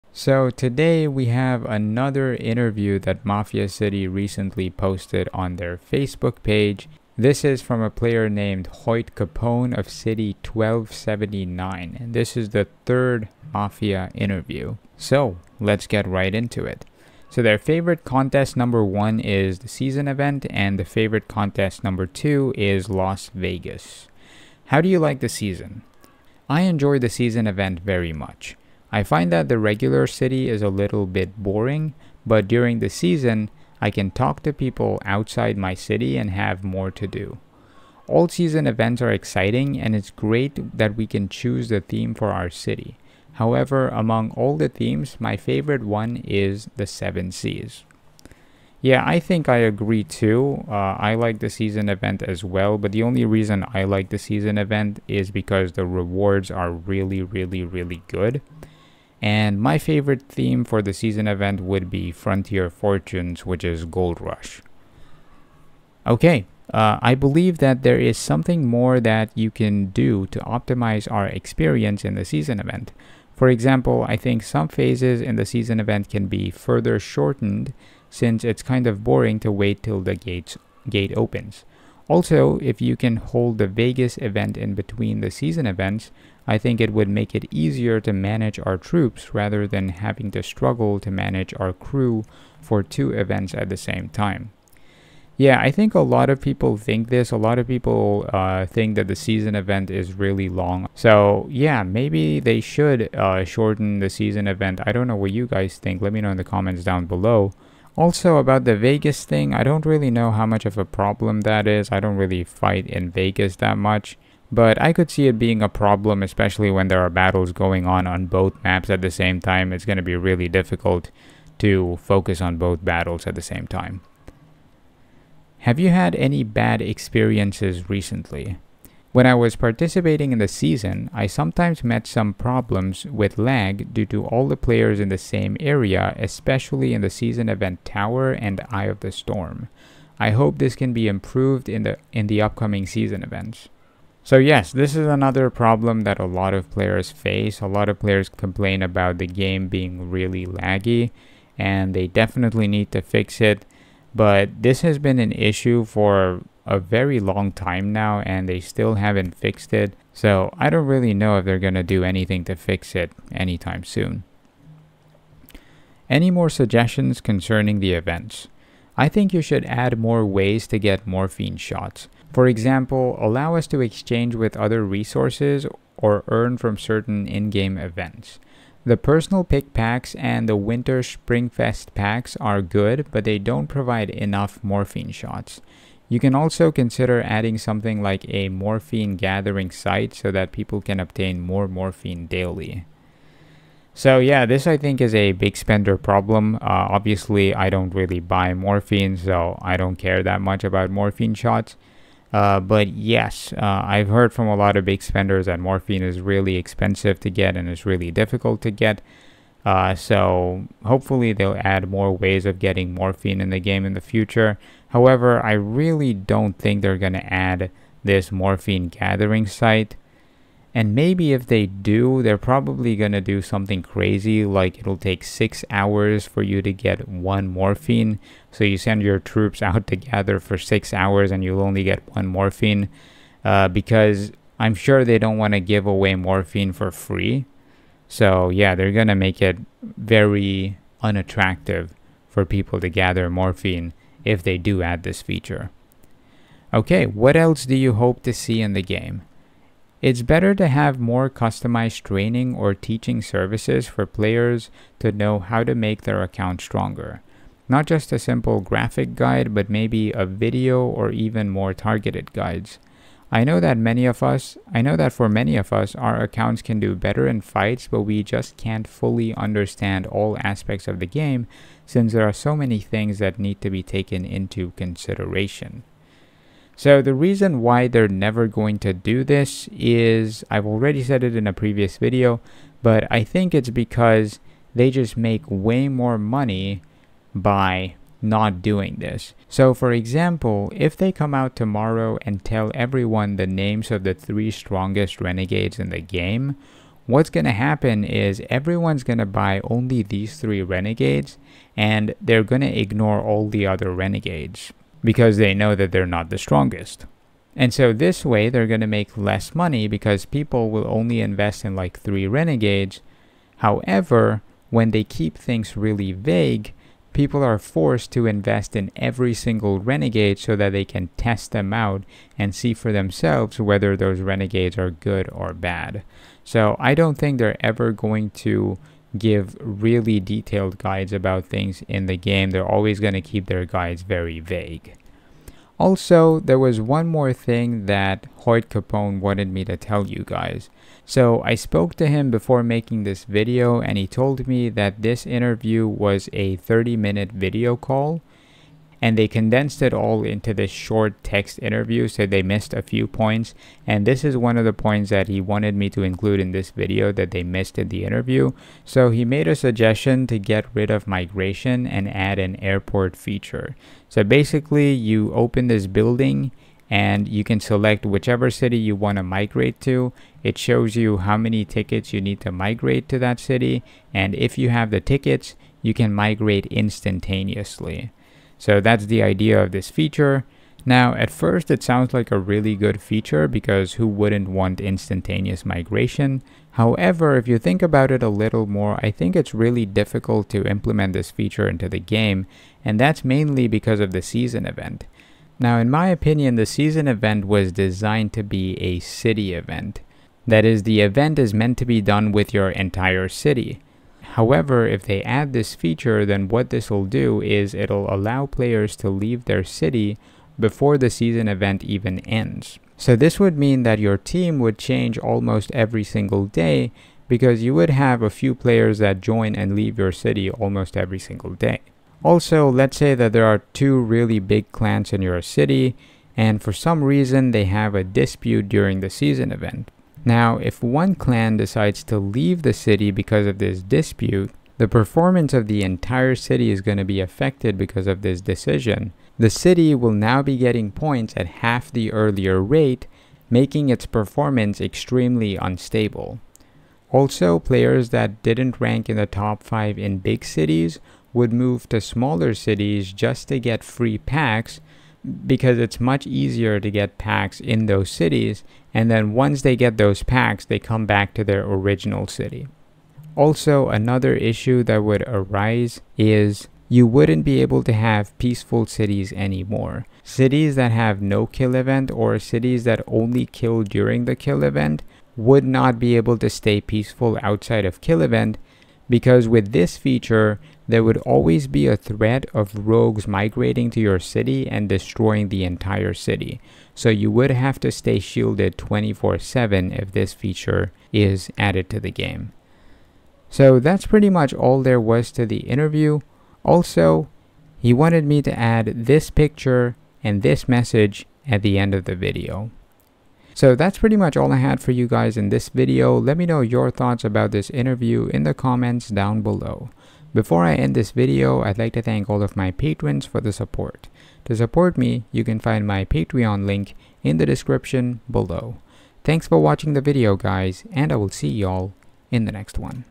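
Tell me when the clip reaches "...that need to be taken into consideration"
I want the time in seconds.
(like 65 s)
273 s.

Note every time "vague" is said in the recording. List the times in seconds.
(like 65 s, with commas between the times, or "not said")
316 s, 334 s.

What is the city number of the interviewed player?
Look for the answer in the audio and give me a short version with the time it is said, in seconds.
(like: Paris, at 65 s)
1279, at 9 s.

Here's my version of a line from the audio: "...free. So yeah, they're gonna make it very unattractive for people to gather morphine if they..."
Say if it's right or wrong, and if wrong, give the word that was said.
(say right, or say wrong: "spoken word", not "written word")
right.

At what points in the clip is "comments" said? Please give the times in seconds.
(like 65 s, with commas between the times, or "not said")
106 s, 508 s.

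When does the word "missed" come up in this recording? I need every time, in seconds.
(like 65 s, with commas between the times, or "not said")
352 s, 357 s.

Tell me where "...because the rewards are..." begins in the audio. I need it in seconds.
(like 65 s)
55 s.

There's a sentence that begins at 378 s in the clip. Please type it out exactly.
So that's the idea of this feature.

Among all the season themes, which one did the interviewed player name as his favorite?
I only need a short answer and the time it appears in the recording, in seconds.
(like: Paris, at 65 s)
Seven Seas, at 46 s.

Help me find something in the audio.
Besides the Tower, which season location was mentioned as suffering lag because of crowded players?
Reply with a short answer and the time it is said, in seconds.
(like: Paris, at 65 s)
Eye of the Storm, at 138 s.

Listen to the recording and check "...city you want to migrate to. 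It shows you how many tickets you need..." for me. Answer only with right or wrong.
right.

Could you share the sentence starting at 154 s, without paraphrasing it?
But this has been an issue for a very long time now and they still haven't fixed it.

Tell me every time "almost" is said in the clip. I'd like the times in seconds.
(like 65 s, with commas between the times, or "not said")
415 s, 420 s.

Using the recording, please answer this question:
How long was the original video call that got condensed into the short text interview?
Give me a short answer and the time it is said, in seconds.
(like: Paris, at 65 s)
30 minutes, at 346 s.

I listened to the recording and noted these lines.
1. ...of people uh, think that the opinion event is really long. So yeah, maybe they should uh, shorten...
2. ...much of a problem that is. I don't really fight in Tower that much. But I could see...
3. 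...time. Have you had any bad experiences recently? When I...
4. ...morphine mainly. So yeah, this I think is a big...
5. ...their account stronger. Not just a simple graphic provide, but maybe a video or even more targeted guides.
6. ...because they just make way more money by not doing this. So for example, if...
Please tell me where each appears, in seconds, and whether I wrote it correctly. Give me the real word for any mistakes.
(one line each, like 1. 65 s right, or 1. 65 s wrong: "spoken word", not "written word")
1. 97 s wrong: "season", not "opinion"
2. 110 s wrong: "Vegas", not "Tower"
3. 123 s right
4. 191 s wrong: "daily", not "mainly"
5. 256 s wrong: "guide", not "provide"
6. 283 s right.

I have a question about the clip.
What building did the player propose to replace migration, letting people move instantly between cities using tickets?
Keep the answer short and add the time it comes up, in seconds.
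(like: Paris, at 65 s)
airport, at 362 s.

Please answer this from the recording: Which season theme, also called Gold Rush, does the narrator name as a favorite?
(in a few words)
Frontier Fortunes.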